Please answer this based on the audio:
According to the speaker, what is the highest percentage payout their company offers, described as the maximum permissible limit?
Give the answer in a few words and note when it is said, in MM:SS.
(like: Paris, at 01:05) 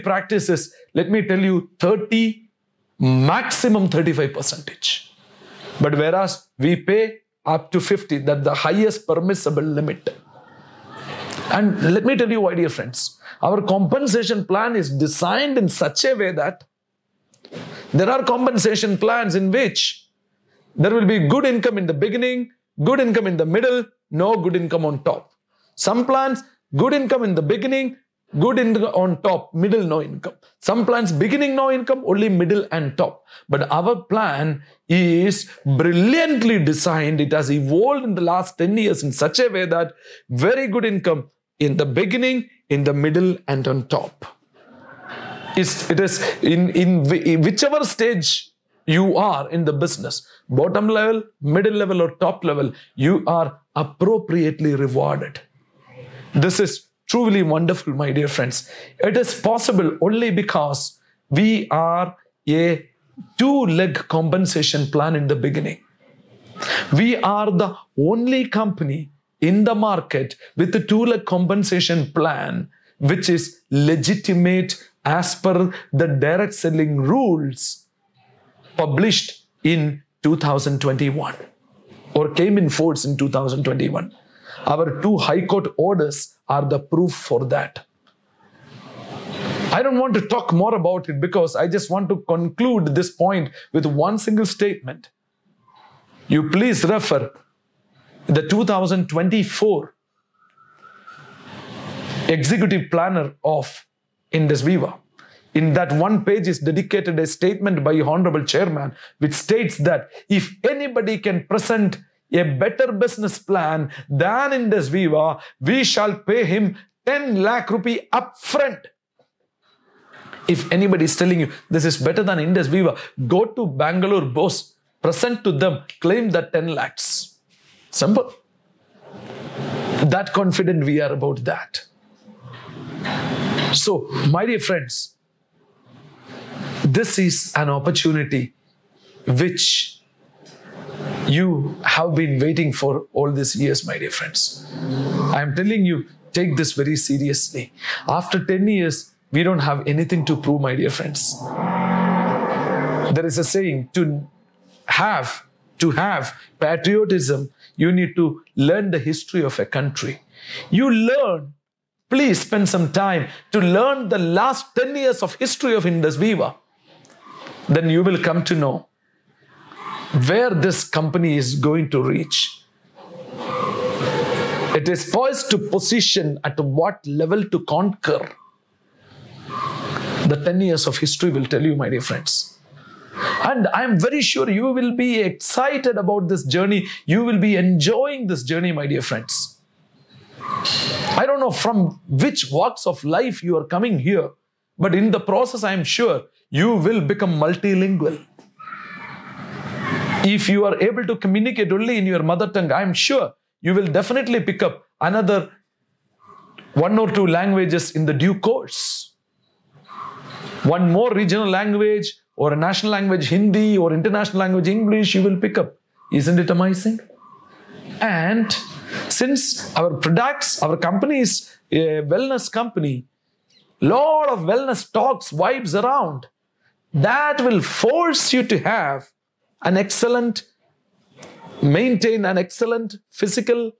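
50, at 00:07.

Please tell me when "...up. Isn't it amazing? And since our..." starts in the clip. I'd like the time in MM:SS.
03:35.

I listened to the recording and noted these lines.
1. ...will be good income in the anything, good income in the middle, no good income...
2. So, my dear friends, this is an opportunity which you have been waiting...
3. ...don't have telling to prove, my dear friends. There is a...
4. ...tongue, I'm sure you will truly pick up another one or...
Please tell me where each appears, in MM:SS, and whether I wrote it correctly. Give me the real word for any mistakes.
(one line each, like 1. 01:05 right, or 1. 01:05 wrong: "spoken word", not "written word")
1. 00:20 wrong: "beginning", not "anything"
2. 02:13 right
3. 02:29 wrong: "anything", not "telling"
4. 03:22 wrong: "definitely", not "truly".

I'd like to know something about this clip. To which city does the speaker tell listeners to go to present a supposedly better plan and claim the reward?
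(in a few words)
Bangalore.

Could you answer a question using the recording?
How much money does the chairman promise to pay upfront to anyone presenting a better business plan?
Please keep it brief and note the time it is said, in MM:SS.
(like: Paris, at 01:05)
10 lakh rupees, at 01:57.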